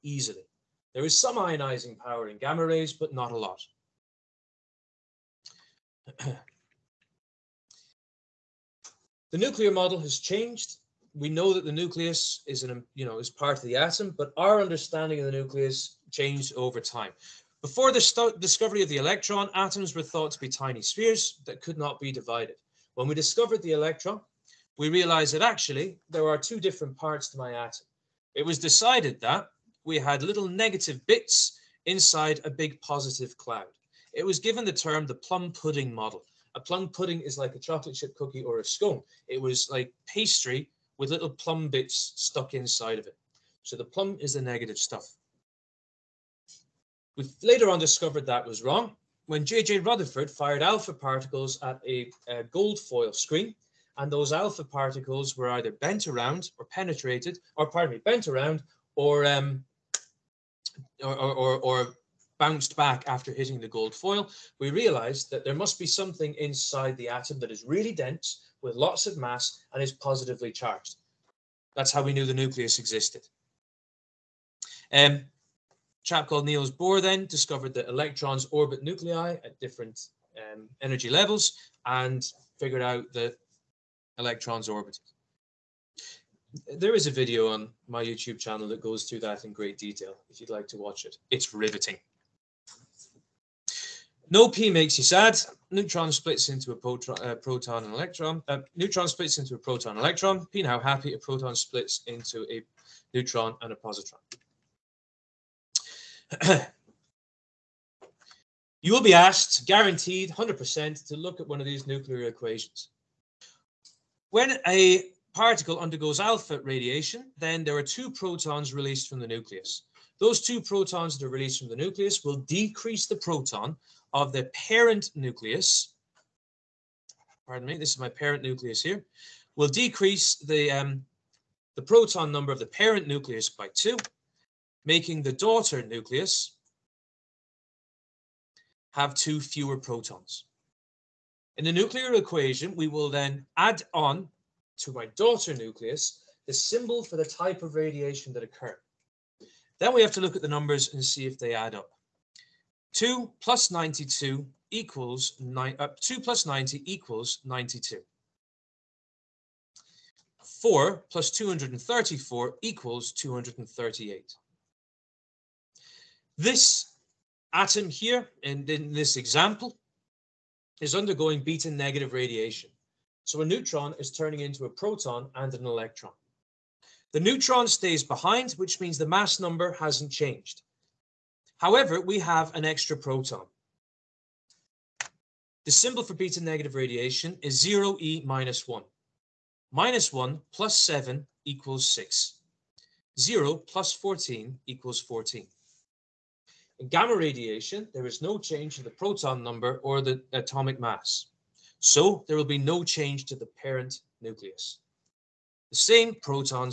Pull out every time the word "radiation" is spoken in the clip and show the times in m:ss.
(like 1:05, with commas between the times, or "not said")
1:56, 2:27, 2:52, 3:06, 3:17.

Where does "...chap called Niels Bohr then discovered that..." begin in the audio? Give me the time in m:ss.
1:16.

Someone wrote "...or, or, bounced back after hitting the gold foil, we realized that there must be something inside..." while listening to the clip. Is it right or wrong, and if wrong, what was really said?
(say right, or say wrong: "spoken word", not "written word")
right.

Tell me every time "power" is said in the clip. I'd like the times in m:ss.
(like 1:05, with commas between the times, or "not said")
0:01.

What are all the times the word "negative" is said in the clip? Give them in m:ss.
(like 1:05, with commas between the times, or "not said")
0:30, 0:44, 2:51, 3:06.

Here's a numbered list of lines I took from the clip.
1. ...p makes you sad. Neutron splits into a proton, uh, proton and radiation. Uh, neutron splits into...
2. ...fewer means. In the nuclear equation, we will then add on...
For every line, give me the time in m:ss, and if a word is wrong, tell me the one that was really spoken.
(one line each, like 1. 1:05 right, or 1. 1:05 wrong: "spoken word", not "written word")
1. 1:34 wrong: "electron", not "radiation"
2. 2:19 wrong: "protons", not "means".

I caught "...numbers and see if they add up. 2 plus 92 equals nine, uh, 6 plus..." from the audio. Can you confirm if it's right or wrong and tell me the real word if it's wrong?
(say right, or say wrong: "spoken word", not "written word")
wrong: "2", not "6".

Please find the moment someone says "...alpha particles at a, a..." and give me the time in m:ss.
0:50.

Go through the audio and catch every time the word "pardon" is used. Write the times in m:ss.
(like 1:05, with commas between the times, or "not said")
0:57, 2:07.